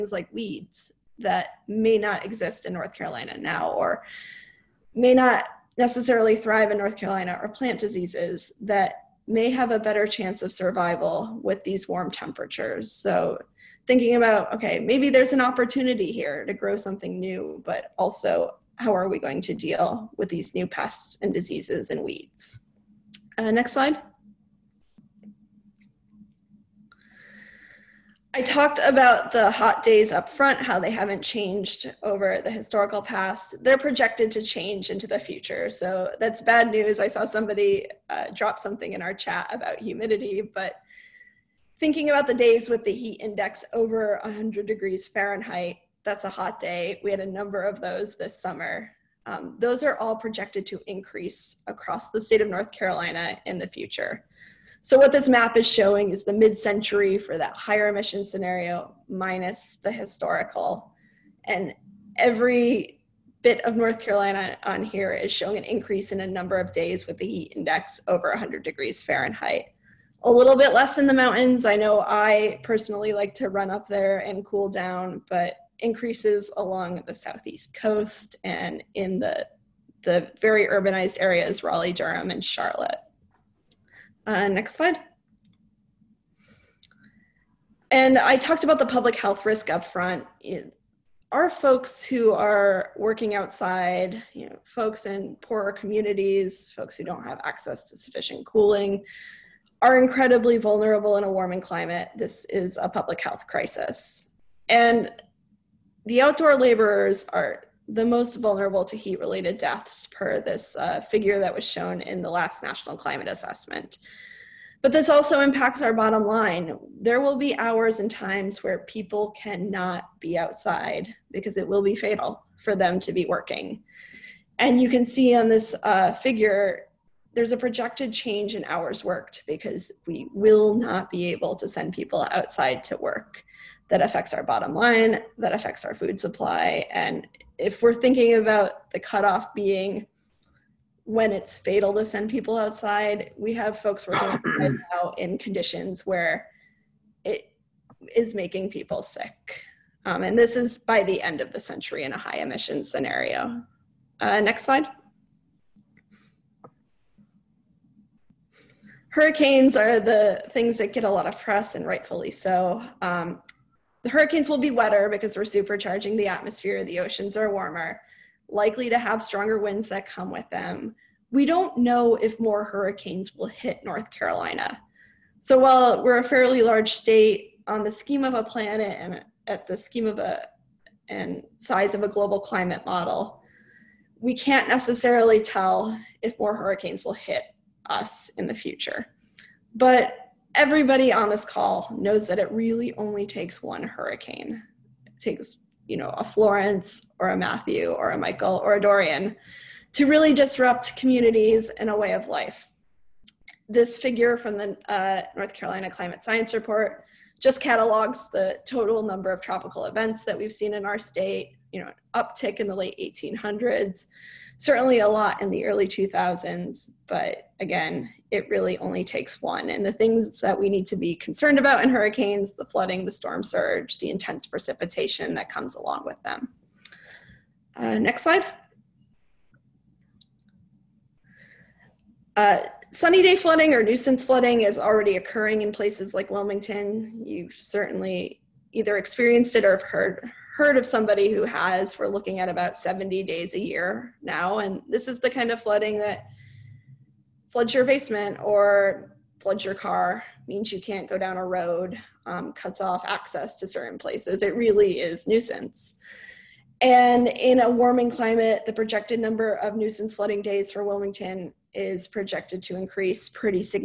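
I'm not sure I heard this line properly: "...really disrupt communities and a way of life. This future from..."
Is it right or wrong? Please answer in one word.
wrong.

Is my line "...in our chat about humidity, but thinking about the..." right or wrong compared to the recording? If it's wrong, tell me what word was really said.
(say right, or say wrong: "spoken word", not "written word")
right.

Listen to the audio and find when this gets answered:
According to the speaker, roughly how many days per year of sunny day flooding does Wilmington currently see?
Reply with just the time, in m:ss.
4:02.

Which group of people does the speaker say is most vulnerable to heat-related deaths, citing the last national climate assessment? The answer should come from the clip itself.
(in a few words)
outdoor laborers.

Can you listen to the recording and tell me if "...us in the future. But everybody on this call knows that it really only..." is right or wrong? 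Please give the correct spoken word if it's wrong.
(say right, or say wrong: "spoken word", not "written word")
right.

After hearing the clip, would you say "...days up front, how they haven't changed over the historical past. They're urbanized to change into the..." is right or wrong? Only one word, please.
wrong.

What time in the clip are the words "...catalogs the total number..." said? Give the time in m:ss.
3:27.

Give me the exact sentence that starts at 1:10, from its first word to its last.
A little bit less in the mountains.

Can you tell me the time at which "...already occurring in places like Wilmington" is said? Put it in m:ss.
3:54.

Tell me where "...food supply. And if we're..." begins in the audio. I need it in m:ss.
2:15.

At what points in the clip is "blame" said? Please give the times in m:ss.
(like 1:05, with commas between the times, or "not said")
not said.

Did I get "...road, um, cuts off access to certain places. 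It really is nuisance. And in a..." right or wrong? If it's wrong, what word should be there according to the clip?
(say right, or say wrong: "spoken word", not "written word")
right.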